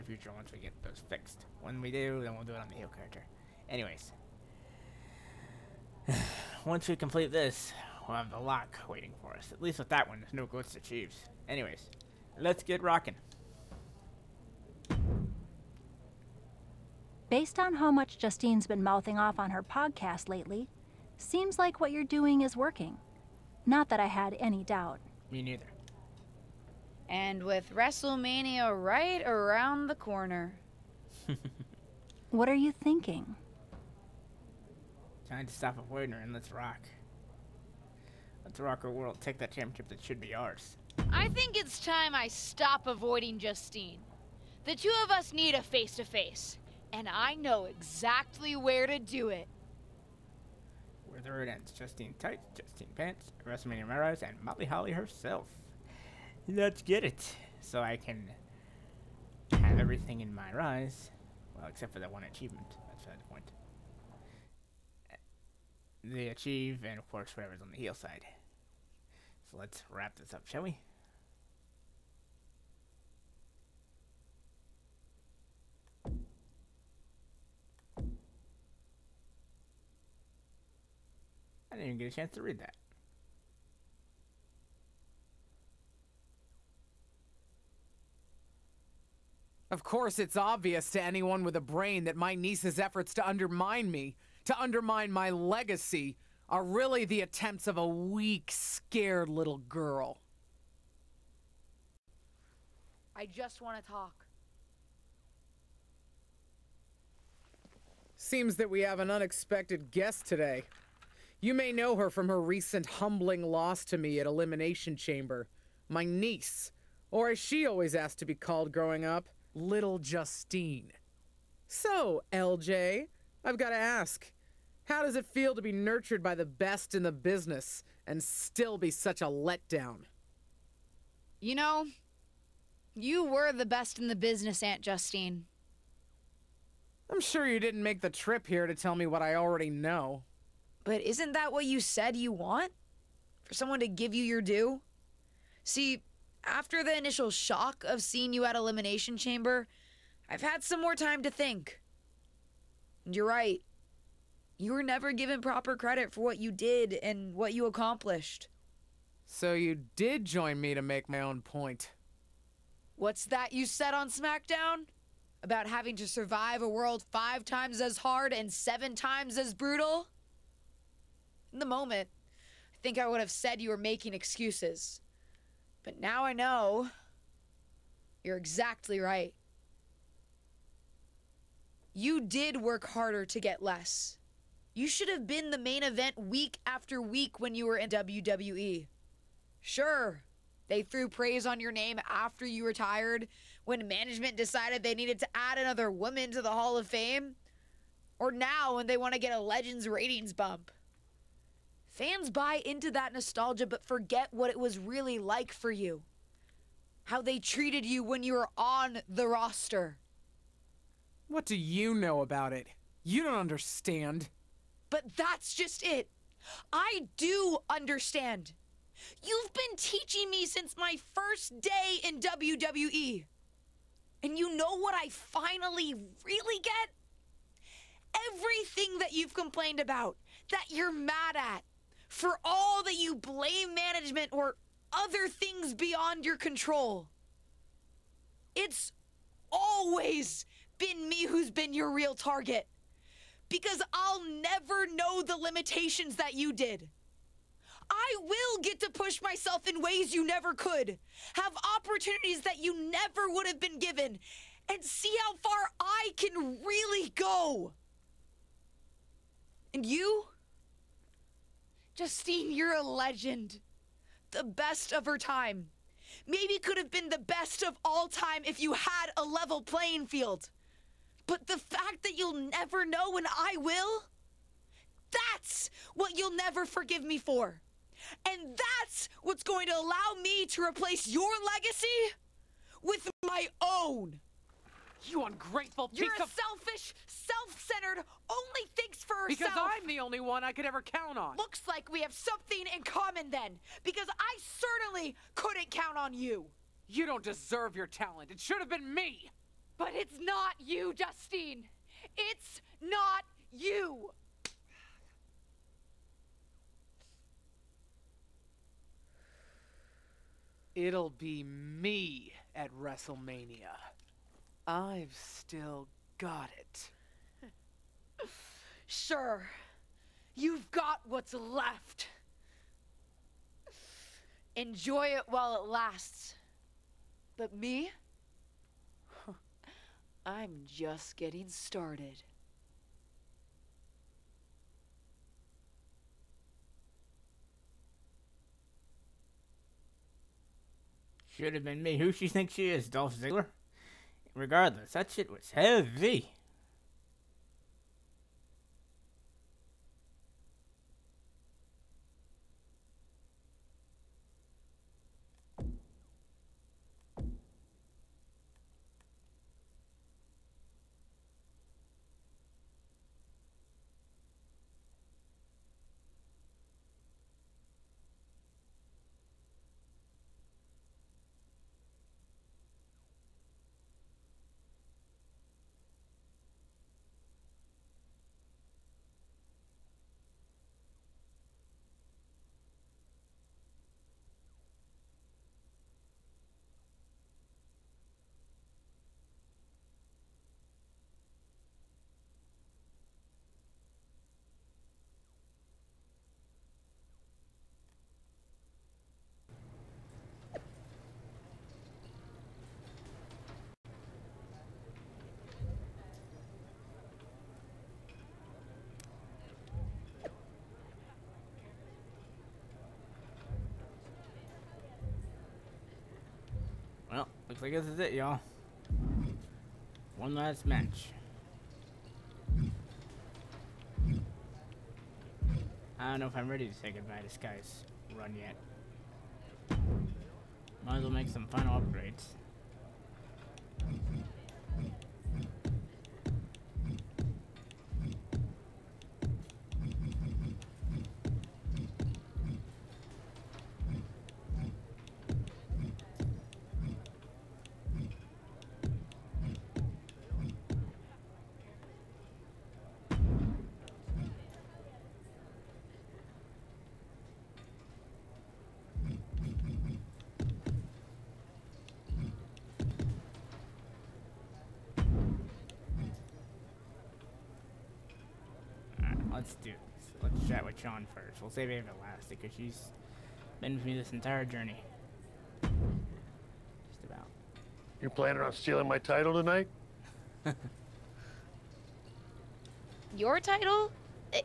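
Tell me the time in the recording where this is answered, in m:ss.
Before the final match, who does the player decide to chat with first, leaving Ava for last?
7:50.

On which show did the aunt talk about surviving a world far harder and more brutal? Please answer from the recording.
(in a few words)
SmackDown.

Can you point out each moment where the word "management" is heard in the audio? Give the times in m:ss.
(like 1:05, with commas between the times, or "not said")
3:13, 3:53.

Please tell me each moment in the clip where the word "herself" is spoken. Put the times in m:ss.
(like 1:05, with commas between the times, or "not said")
0:54, 4:49.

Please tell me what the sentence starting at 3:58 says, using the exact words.
It's always been me who's been your real target.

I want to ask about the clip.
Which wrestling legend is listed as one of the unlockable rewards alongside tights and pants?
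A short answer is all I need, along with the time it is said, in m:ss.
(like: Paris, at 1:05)
Molly Holly, at 0:54.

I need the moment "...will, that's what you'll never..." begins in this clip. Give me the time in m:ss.
4:33.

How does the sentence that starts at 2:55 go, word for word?
But now I know you're exactly right.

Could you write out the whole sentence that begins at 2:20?
But isn't that what you said you want?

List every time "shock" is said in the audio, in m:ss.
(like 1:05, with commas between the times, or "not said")
2:27.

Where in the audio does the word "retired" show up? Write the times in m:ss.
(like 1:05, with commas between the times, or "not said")
3:12.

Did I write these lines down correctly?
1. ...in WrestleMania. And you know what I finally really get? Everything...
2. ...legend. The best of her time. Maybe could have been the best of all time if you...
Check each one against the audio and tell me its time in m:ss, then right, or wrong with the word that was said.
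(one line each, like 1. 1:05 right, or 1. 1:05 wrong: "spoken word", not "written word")
1. 3:42 wrong: "WWE", not "WrestleMania"
2. 4:22 right.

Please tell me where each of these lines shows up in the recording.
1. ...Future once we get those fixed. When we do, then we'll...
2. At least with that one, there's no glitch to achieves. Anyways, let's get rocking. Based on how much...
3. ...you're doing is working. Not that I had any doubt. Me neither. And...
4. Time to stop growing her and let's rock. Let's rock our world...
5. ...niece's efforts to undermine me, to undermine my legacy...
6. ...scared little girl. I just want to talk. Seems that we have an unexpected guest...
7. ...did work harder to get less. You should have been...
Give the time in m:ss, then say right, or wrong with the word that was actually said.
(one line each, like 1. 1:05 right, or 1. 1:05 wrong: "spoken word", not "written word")
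1. 0:00 right
2. 0:09 right
3. 0:21 right
4. 0:35 wrong: "avoiding", not "growing"
5. 1:32 right
6. 1:38 right
7. 3:02 right.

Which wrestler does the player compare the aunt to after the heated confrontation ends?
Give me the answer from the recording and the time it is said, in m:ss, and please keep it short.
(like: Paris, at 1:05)
Dolph Ziggler, at 5:42.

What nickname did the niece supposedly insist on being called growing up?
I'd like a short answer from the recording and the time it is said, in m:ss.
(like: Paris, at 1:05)
little Justine, at 1:59.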